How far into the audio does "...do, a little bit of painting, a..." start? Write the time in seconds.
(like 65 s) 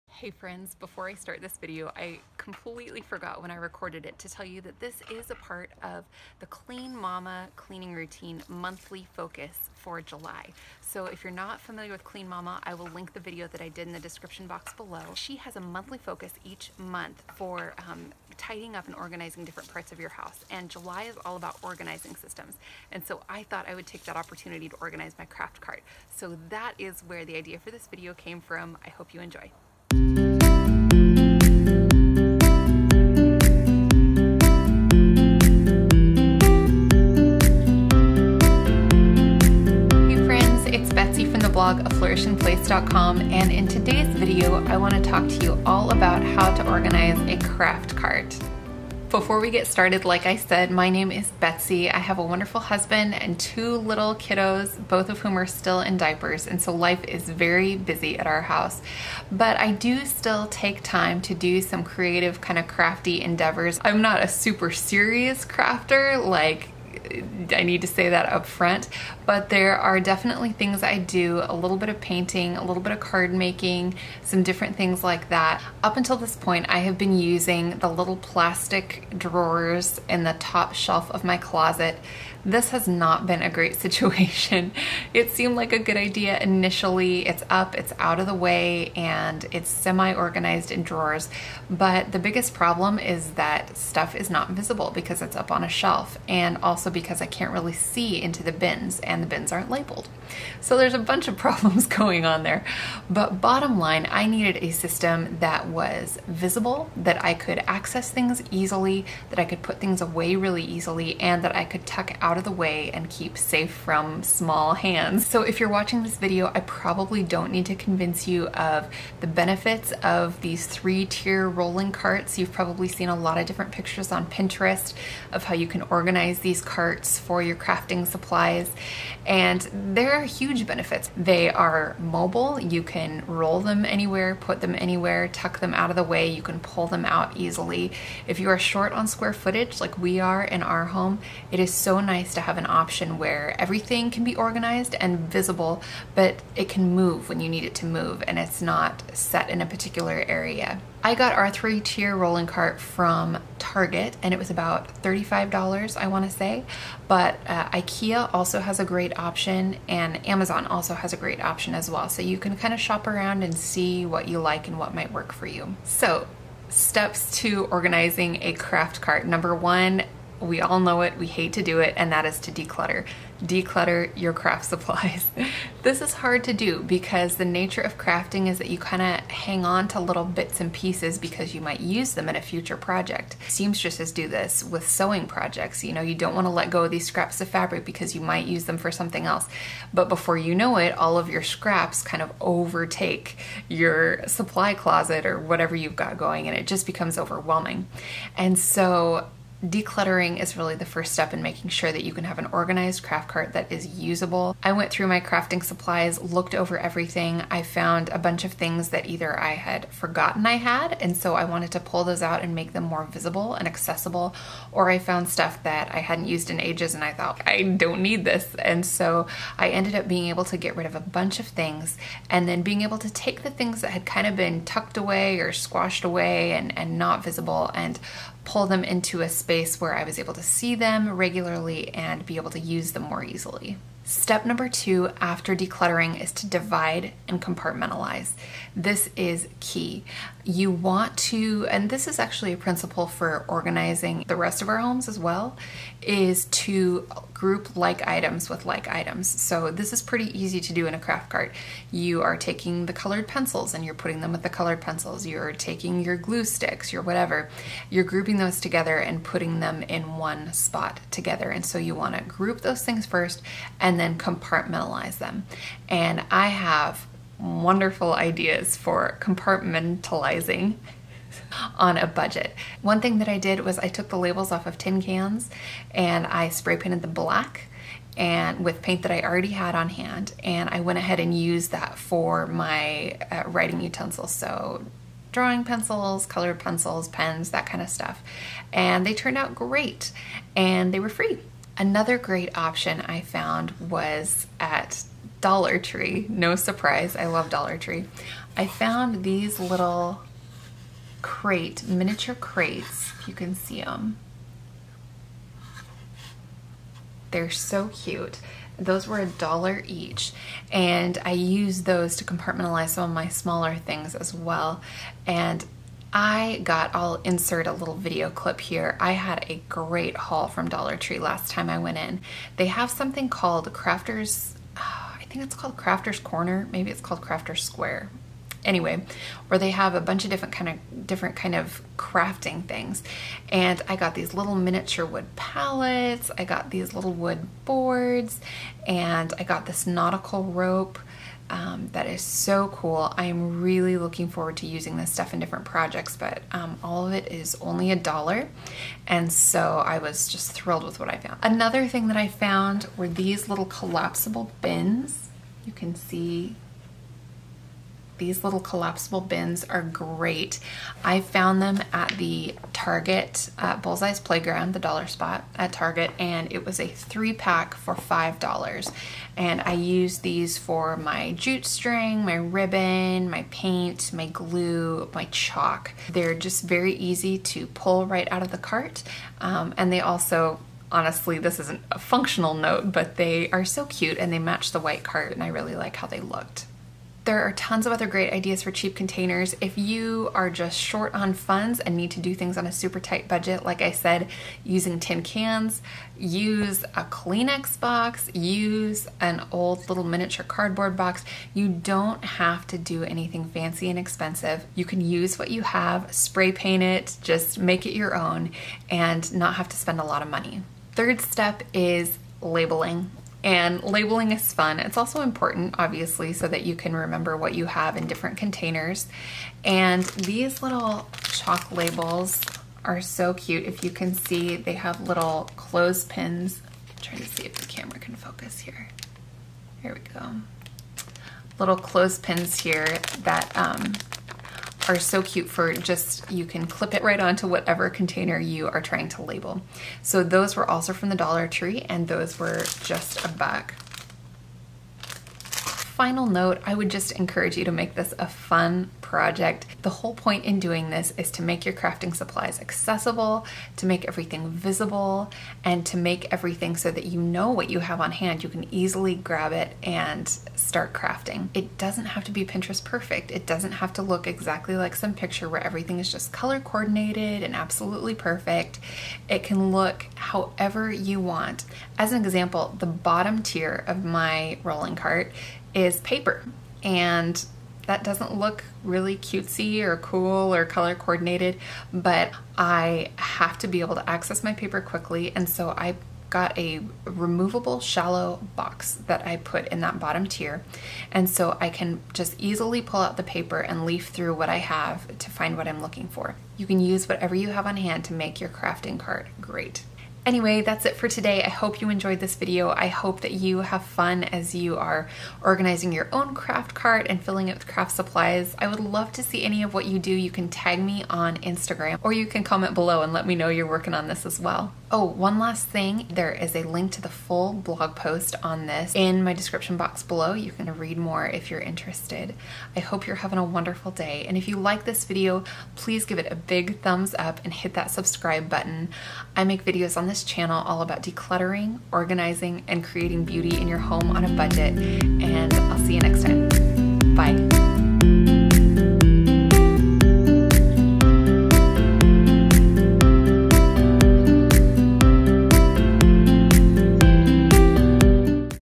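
70 s.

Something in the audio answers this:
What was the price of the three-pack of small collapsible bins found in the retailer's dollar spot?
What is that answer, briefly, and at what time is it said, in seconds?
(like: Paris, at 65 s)
$5, at 367 s.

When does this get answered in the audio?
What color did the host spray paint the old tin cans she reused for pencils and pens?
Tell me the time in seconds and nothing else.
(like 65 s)
277 s.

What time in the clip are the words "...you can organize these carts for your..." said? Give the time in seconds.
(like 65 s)
125 s.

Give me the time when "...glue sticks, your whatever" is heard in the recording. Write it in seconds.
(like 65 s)
256 s.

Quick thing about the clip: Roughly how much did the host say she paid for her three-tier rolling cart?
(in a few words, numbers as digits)
$35.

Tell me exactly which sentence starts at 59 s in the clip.
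But I do still take time to do some creative, kind of crafty endeavors.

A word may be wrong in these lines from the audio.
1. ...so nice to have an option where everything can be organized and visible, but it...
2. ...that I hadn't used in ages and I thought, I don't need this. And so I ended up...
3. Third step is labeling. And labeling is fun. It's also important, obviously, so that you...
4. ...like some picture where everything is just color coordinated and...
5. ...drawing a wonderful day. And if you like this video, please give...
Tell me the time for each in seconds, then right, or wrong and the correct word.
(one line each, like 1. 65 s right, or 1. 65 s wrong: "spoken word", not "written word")
1. 141 s right
2. 215 s right
3. 410 s right
4. 464 s right
5. 523 s wrong: "having", not "drawing".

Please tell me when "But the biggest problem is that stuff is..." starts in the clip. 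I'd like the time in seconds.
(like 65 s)
91 s.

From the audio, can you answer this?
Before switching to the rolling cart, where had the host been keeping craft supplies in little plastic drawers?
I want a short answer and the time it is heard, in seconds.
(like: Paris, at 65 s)
top shelf of my closet, at 80 s.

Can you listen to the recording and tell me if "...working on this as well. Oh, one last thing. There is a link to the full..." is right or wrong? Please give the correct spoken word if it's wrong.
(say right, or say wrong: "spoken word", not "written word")
right.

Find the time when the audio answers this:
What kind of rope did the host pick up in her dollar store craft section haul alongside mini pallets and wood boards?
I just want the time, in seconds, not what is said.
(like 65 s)
339 s.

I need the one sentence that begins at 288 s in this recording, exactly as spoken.
And they turned out great and they were free.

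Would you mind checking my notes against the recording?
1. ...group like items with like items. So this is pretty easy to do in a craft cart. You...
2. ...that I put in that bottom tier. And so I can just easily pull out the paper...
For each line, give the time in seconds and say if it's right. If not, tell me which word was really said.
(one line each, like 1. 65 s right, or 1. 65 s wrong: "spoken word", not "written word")
1. 247 s right
2. 489 s right.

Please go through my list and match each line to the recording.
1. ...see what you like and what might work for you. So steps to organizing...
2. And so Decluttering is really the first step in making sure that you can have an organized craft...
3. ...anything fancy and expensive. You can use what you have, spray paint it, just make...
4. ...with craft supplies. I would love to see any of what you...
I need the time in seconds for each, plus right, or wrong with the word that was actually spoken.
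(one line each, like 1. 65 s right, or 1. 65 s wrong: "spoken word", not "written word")
1. 163 s right
2. 198 s right
3. 403 s right
4. 507 s right.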